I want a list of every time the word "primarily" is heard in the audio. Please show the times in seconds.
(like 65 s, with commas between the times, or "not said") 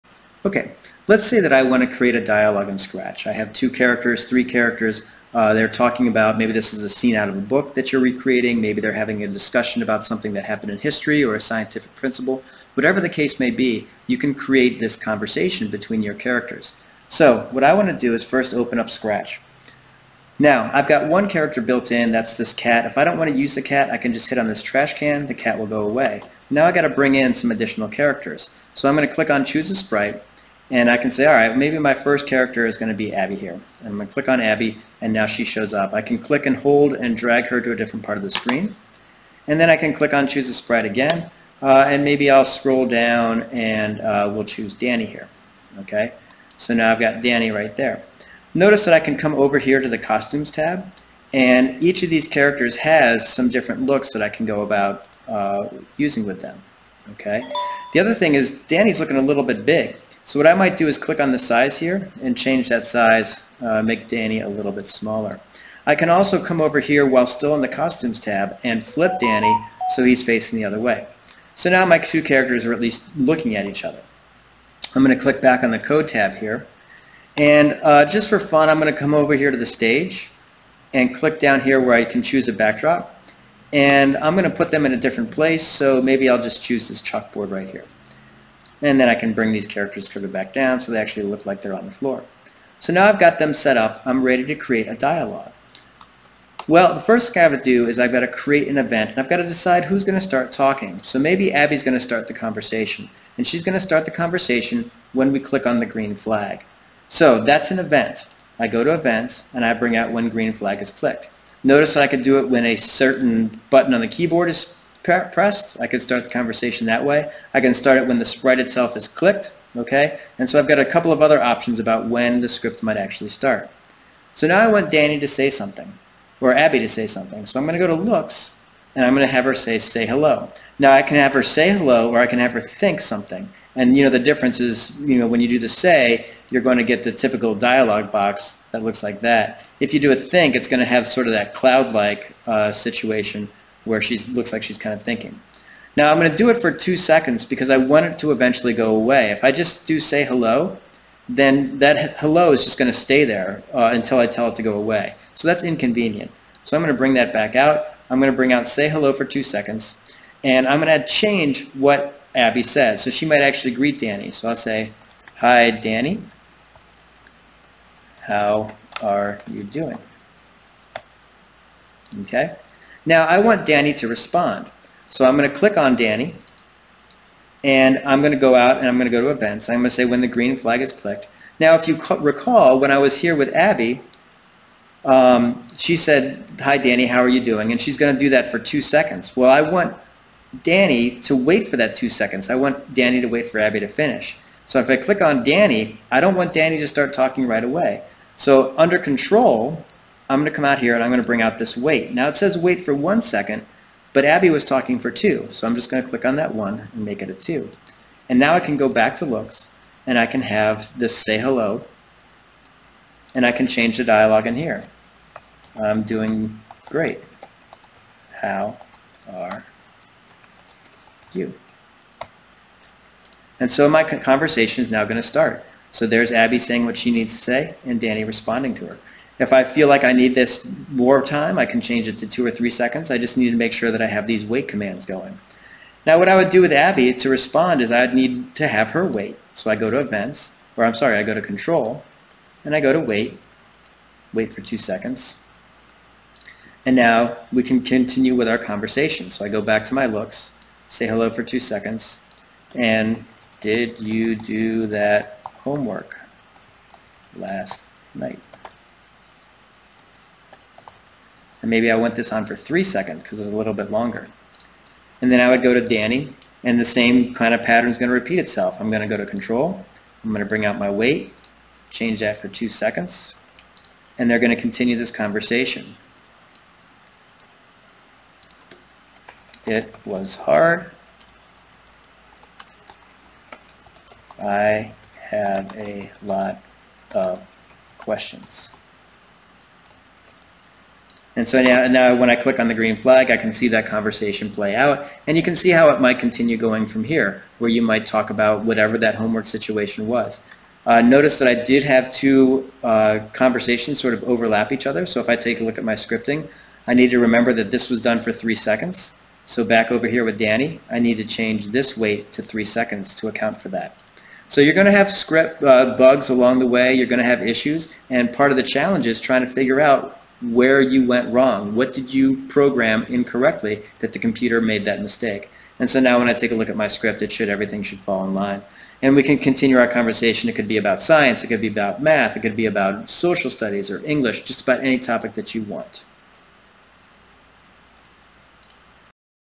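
not said.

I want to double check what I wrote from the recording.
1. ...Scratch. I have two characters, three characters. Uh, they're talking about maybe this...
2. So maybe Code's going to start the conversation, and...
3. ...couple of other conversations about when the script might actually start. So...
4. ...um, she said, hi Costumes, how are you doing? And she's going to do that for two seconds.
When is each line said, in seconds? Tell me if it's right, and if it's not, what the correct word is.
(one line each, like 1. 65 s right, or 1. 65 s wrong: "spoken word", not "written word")
1. 2 s right
2. 101 s wrong: "Abby", not "Code"
3. 120 s wrong: "options", not "conversations"
4. 185 s wrong: "Danny", not "Costumes".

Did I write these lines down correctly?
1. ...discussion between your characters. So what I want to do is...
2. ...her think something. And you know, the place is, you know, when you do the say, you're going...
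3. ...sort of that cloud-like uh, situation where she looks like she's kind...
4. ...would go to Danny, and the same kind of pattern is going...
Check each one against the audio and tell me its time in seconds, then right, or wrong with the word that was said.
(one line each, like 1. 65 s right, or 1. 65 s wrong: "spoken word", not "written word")
1. 14 s wrong: "conversation", not "discussion"
2. 132 s wrong: "difference", not "place"
3. 141 s right
4. 265 s right.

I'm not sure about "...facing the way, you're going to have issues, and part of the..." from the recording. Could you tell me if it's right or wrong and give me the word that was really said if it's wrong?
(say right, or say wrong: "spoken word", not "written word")
wrong: "along", not "facing".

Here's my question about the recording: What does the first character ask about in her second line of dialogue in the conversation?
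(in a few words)
Homework last night.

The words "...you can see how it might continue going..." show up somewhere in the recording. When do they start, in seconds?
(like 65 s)
295 s.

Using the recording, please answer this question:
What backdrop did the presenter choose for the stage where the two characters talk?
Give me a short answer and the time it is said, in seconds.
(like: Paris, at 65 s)
Chalkboard, at 87 s.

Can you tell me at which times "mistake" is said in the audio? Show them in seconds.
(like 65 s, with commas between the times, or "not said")
325 s.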